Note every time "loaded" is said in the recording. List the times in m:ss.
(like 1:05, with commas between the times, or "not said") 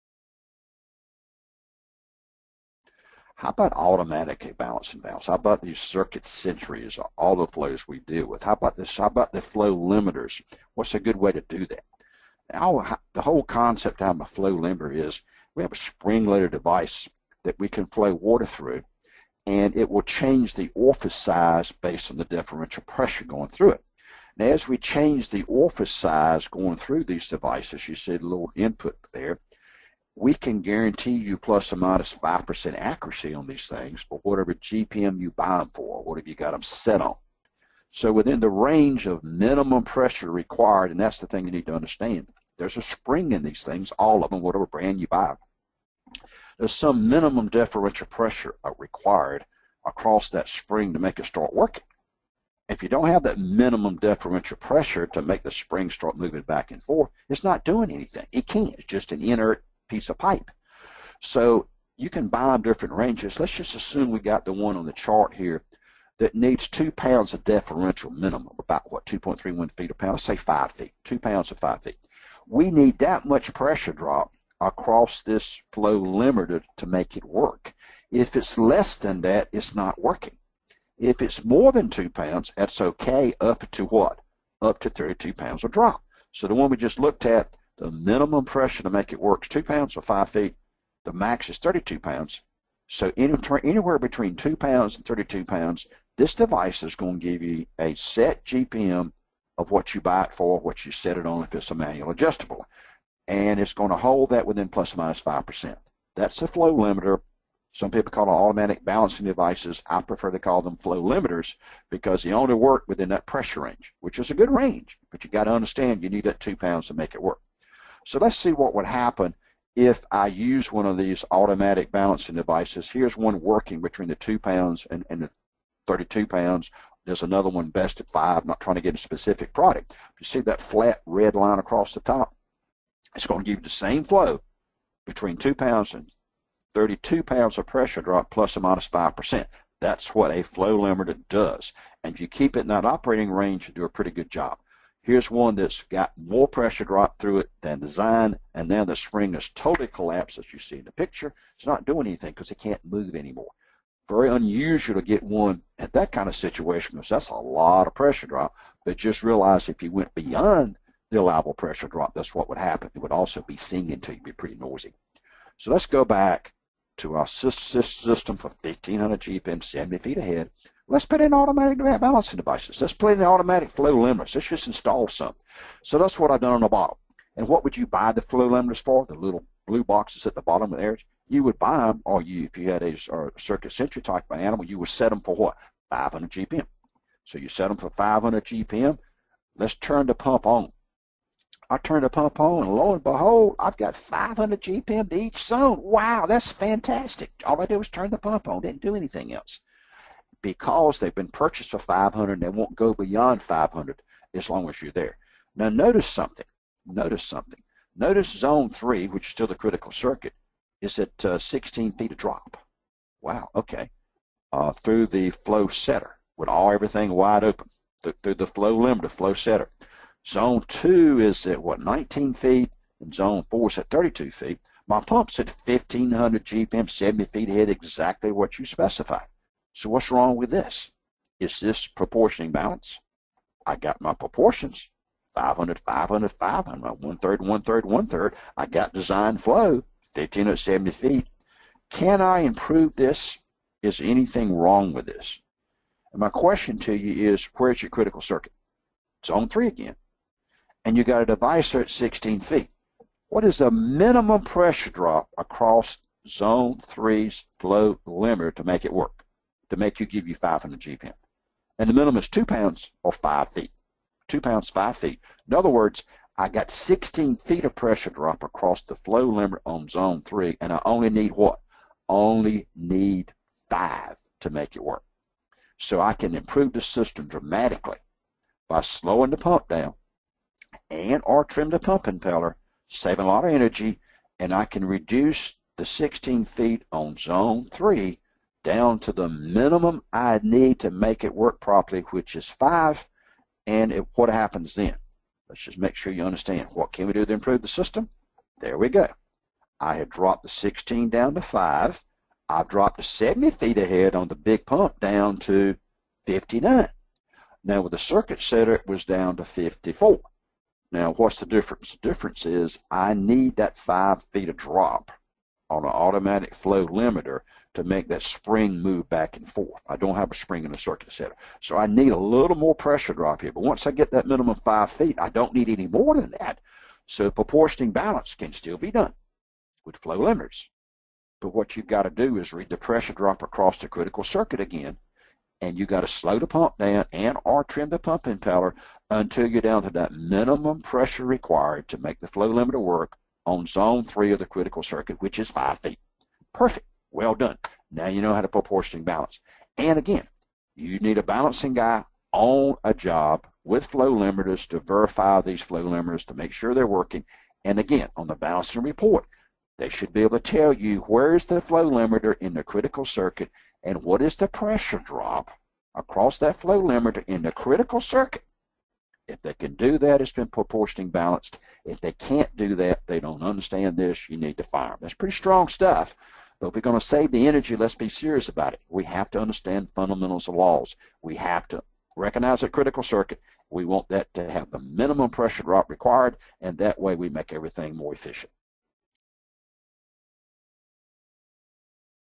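0:15.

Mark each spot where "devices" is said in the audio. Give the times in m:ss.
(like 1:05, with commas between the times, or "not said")
0:16, 0:27, 1:36, 1:49, 2:02, 2:52.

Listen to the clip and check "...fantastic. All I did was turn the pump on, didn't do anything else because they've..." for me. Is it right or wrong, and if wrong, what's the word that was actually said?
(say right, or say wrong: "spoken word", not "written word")
right.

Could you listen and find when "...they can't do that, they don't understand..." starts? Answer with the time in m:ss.
6:11.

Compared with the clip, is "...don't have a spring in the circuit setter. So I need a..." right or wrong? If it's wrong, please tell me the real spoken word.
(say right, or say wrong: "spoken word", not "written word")
right.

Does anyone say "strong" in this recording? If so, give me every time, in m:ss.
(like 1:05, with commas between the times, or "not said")
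6:15.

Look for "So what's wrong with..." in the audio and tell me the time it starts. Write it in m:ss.
3:49.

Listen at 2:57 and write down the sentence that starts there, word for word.
And what would you buy the flow limiters for?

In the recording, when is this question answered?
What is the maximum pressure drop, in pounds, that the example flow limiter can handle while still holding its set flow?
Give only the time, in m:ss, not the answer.
1:24.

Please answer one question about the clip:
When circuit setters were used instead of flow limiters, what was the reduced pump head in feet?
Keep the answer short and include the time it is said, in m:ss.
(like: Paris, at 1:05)
54, at 5:09.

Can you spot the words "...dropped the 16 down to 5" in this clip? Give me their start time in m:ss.
5:00.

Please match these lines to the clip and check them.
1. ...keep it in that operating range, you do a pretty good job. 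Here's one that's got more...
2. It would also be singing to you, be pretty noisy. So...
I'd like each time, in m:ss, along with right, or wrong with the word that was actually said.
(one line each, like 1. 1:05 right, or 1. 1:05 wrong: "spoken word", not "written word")
1. 2:22 right
2. 2:42 right.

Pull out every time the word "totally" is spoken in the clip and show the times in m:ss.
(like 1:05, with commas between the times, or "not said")
2:29.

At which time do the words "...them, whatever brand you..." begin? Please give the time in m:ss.
0:44.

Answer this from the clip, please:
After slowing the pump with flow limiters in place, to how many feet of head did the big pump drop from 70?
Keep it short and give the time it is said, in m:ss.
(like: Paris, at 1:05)
59, at 5:06.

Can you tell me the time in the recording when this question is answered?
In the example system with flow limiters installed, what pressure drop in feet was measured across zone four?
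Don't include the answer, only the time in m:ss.
3:43.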